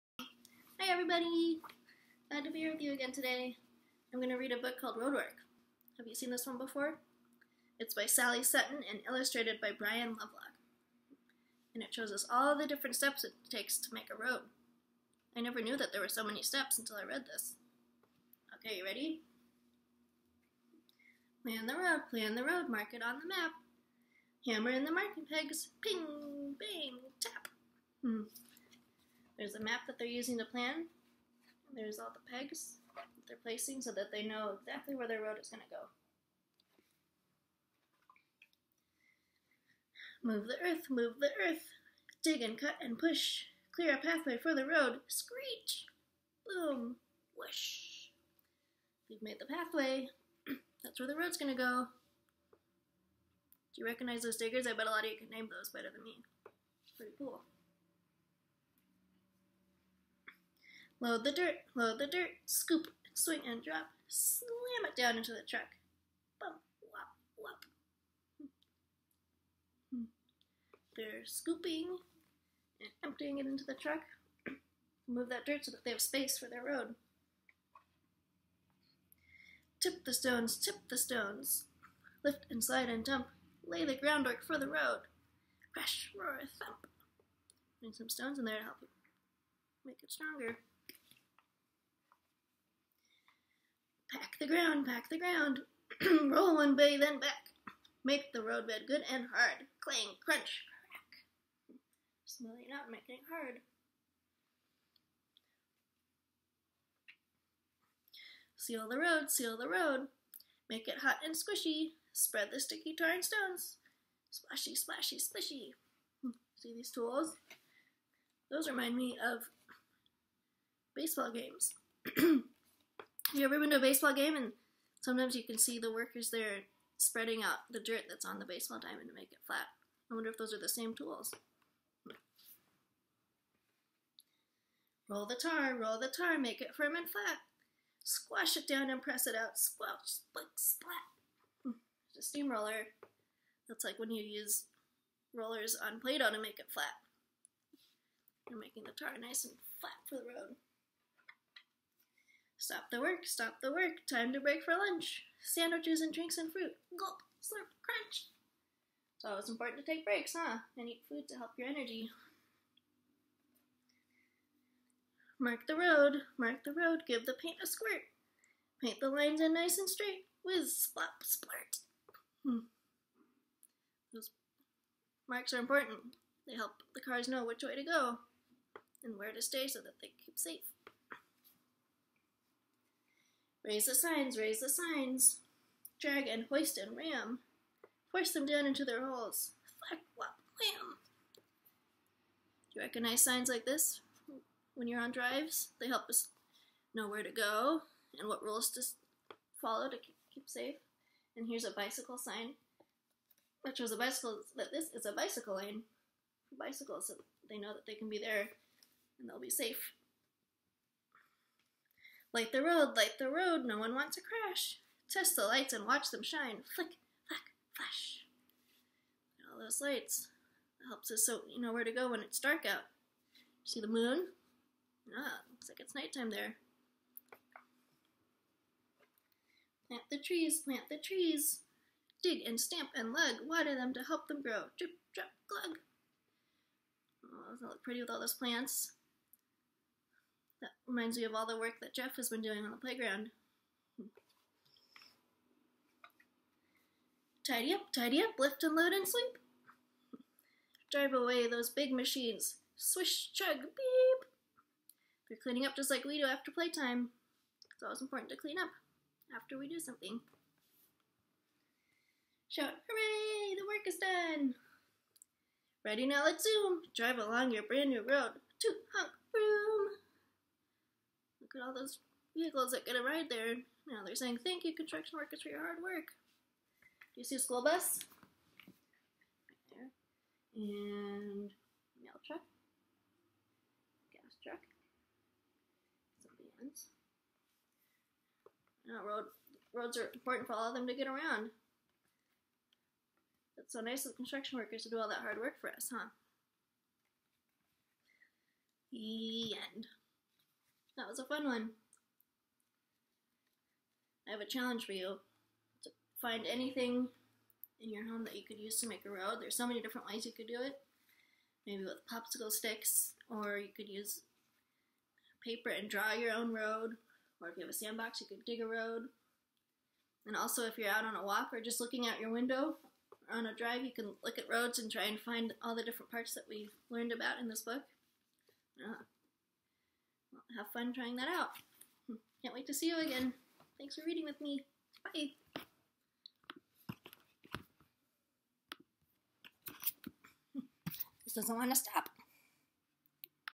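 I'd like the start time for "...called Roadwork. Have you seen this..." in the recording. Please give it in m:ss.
0:04.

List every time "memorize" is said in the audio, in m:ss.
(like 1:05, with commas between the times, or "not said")
not said.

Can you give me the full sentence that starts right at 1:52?
Spread the sticky tar and stones.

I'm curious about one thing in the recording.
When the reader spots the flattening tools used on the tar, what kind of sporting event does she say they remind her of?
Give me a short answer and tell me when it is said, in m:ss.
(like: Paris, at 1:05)
Baseball games, at 2:00.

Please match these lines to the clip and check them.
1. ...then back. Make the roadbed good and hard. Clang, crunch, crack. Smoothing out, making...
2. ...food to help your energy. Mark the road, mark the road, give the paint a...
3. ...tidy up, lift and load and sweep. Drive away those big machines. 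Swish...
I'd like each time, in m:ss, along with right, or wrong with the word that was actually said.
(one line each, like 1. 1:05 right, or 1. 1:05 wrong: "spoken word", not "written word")
1. 1:36 right
2. 2:41 right
3. 4:07 right.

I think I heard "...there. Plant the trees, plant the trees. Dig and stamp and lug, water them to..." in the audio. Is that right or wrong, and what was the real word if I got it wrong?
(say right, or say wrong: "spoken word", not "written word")
right.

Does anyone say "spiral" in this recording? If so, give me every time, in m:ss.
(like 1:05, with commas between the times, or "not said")
not said.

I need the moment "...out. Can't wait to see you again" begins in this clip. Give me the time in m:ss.
5:31.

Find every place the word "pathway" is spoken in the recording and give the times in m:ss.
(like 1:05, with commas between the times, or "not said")
0:43, 0:49.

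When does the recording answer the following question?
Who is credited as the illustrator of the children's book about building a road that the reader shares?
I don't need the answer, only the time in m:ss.
0:09.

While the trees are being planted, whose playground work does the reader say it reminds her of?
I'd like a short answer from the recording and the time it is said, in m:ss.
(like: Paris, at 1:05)
Jeff, at 4:01.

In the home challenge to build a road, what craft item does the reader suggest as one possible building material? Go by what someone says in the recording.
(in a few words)
Popsicle sticks.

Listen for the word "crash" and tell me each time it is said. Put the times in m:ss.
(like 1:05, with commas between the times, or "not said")
1:25, 3:34.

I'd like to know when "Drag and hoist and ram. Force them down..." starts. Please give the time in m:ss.
3:05.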